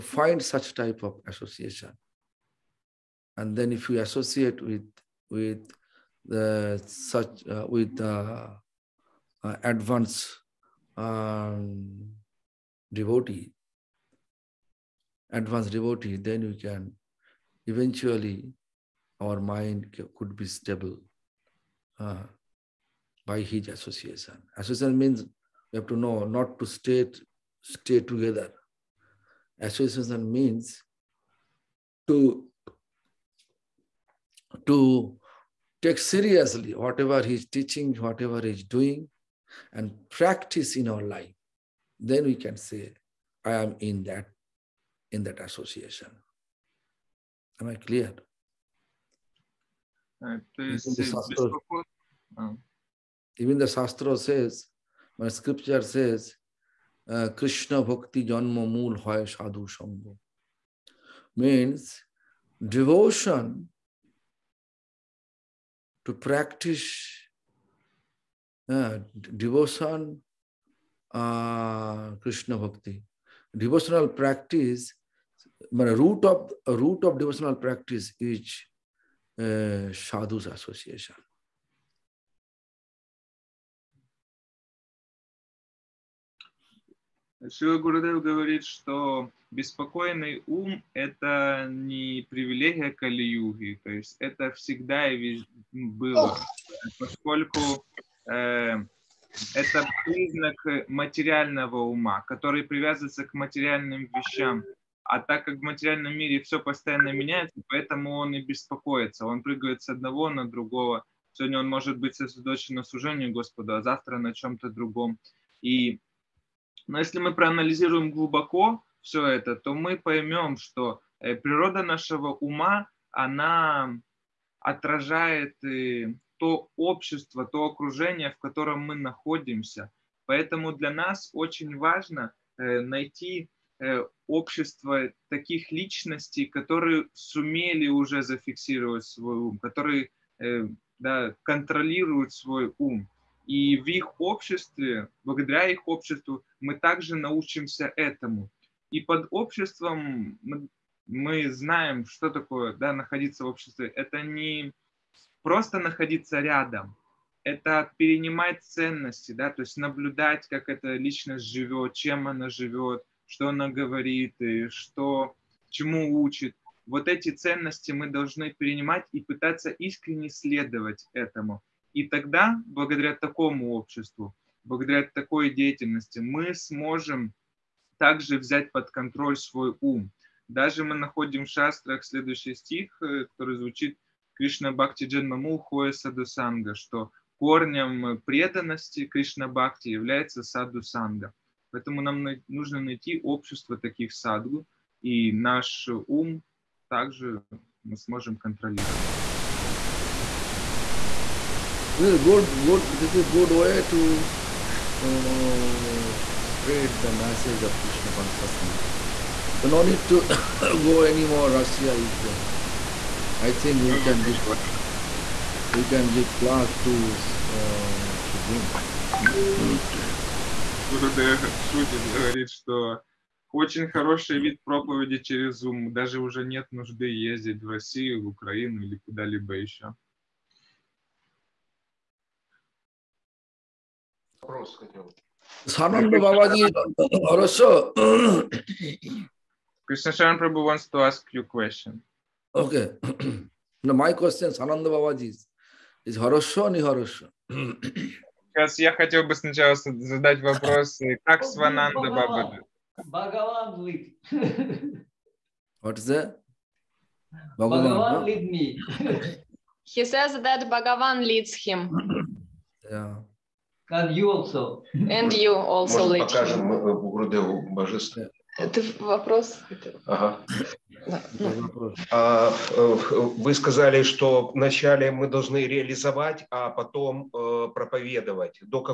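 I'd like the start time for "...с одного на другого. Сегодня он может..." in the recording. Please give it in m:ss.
1:49.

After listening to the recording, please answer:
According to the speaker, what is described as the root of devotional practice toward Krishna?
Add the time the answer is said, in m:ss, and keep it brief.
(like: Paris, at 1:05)
Sadhu's association, at 1:19.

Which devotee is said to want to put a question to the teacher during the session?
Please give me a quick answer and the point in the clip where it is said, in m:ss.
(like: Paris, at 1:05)
Krishna Sharan Prabhu, at 3:59.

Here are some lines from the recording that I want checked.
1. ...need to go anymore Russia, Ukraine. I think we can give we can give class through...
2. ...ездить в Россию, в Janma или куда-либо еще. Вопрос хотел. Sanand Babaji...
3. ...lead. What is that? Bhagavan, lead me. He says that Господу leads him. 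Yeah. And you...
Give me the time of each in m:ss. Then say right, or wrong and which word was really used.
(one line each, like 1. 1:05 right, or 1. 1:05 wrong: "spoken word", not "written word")
1. 3:29 right
2. 3:47 wrong: "Украину", not "Janma"
3. 4:13 wrong: "Багаван", not "Господу".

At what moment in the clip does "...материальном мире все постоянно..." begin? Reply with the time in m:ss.
1:45.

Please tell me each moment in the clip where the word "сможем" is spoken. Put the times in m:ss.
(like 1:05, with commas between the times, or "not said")
2:56, 3:17.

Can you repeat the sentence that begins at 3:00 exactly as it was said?
Даже мы находим в шастрах следующий стих, э, который звучит Кришна Бхакти Джанмаму Хоя Садусанга, что корнем преданности Кришна Бхакти является Садусанга.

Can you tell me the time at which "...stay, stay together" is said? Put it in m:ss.
0:26.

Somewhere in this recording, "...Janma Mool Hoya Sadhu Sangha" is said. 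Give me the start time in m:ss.
0:58.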